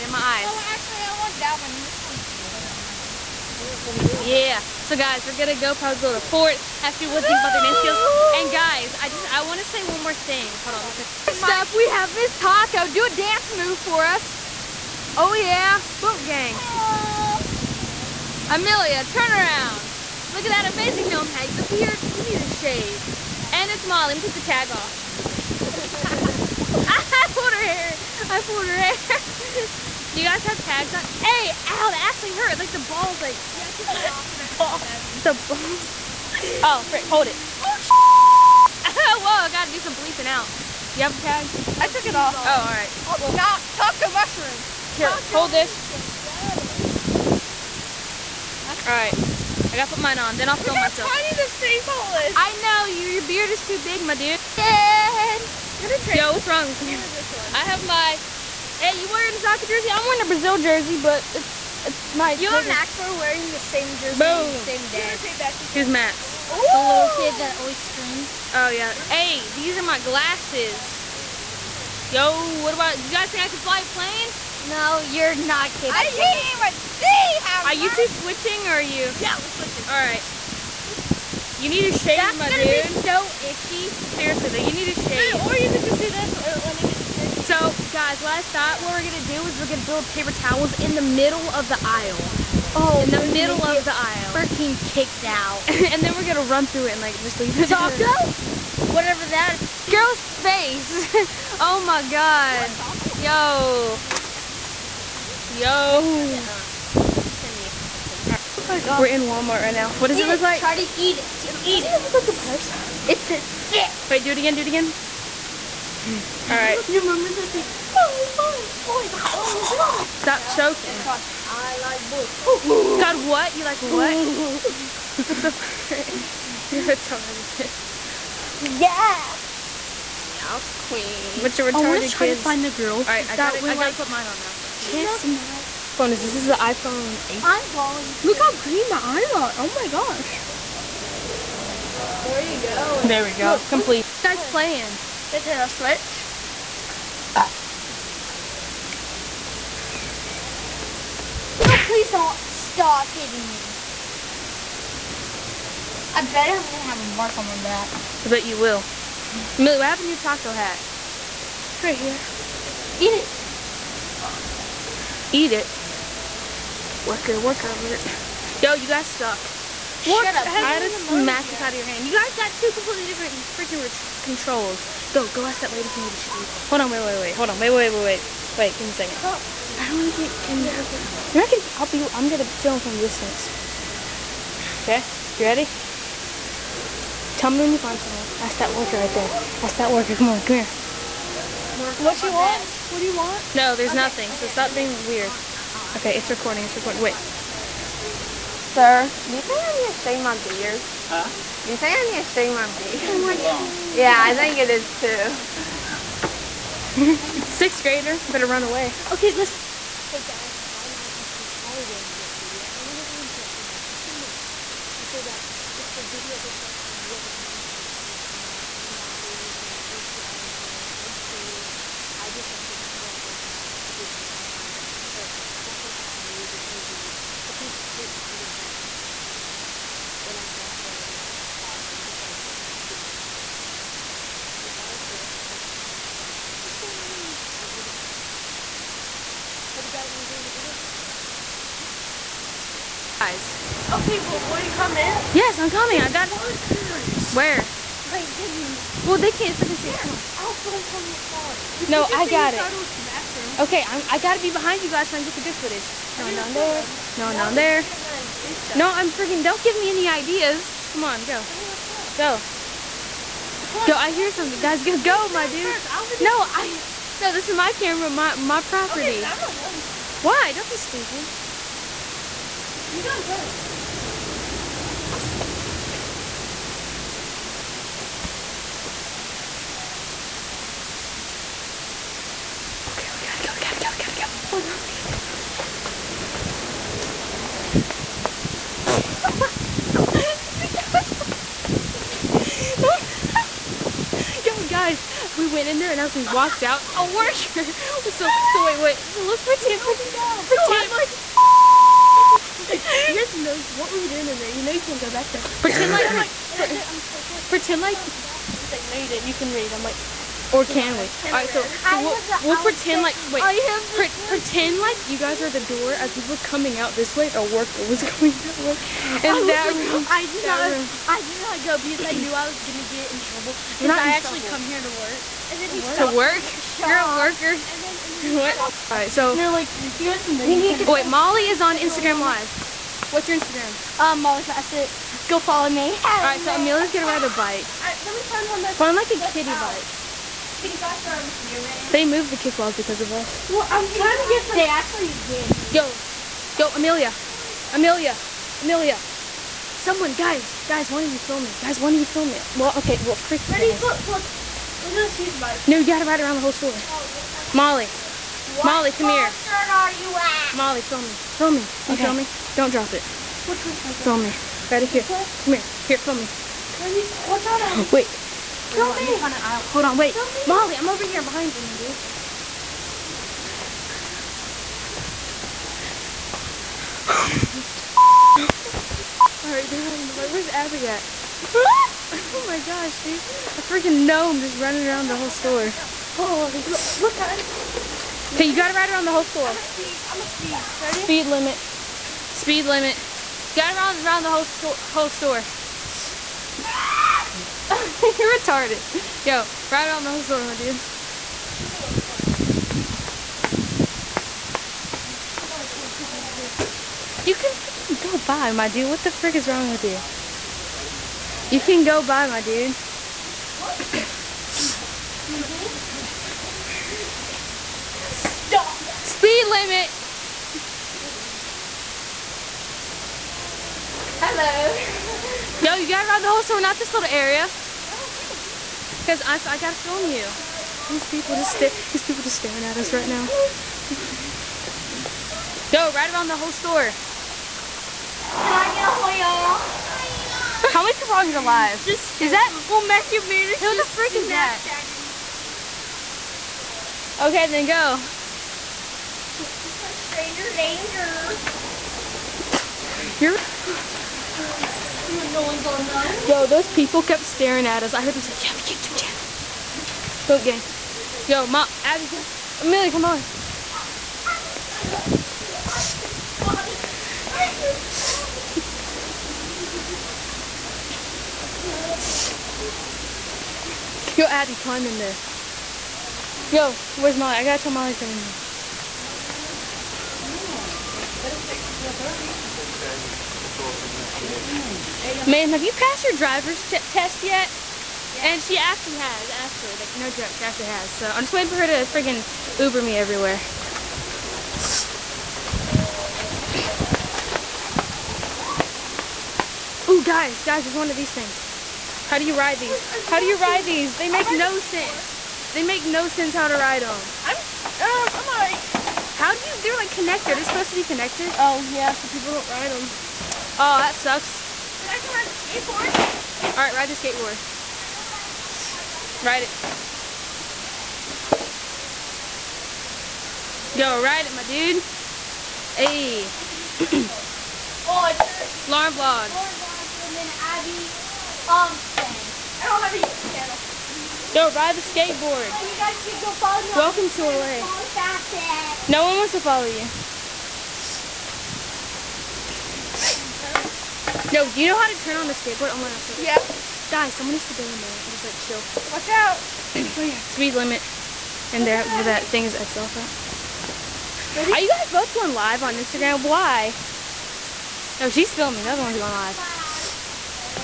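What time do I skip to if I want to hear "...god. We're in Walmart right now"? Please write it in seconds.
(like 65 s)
108 s.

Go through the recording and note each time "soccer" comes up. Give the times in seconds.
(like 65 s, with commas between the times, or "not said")
59 s.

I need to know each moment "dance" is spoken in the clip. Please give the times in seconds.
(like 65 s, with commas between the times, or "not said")
7 s, 13 s.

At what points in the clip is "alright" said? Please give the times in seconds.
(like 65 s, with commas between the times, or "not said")
116 s, 379 s, 508 s, 516 s.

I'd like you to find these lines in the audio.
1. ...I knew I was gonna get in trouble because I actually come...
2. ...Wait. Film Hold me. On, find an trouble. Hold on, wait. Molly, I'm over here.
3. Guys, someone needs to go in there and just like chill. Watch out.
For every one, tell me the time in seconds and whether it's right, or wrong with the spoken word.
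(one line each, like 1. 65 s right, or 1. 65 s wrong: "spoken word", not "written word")
1. 322 s right
2. 367 s wrong: "aisle", not "trouble"
3. 546 s right.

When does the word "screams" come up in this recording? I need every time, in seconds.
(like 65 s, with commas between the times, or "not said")
67 s.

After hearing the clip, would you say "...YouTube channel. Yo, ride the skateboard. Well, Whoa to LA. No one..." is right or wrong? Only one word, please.
wrong.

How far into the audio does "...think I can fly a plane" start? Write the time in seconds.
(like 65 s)
73 s.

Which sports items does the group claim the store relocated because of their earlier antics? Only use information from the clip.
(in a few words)
Kickballs.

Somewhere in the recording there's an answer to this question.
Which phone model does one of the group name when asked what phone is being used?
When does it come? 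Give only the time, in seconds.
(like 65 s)
136 s.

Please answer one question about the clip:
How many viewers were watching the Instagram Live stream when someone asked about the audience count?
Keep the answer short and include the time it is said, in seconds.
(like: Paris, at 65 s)
2, at 441 s.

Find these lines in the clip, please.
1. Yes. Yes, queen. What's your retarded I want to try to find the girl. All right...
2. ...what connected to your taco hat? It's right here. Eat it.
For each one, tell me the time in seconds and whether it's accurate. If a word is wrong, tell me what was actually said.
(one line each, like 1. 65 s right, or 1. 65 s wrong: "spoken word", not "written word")
1. 128 s right
2. 159 s wrong: "happened", not "connected".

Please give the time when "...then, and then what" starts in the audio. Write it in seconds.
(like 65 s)
327 s.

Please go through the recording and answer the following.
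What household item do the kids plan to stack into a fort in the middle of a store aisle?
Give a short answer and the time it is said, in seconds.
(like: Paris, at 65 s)
Paper towels, at 90 s.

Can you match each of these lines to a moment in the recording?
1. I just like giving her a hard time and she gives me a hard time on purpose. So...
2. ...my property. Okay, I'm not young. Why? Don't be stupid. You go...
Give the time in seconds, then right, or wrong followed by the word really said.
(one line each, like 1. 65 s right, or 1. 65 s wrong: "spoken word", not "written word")
1. 222 s right
2. 268 s right.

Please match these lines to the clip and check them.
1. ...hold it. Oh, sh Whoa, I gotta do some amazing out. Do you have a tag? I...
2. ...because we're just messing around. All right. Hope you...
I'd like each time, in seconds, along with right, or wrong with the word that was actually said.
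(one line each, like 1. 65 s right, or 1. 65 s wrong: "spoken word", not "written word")
1. 37 s wrong: "bleeping", not "amazing"
2. 237 s right.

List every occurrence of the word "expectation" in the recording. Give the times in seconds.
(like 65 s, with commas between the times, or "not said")
not said.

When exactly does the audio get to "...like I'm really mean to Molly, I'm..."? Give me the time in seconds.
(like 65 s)
216 s.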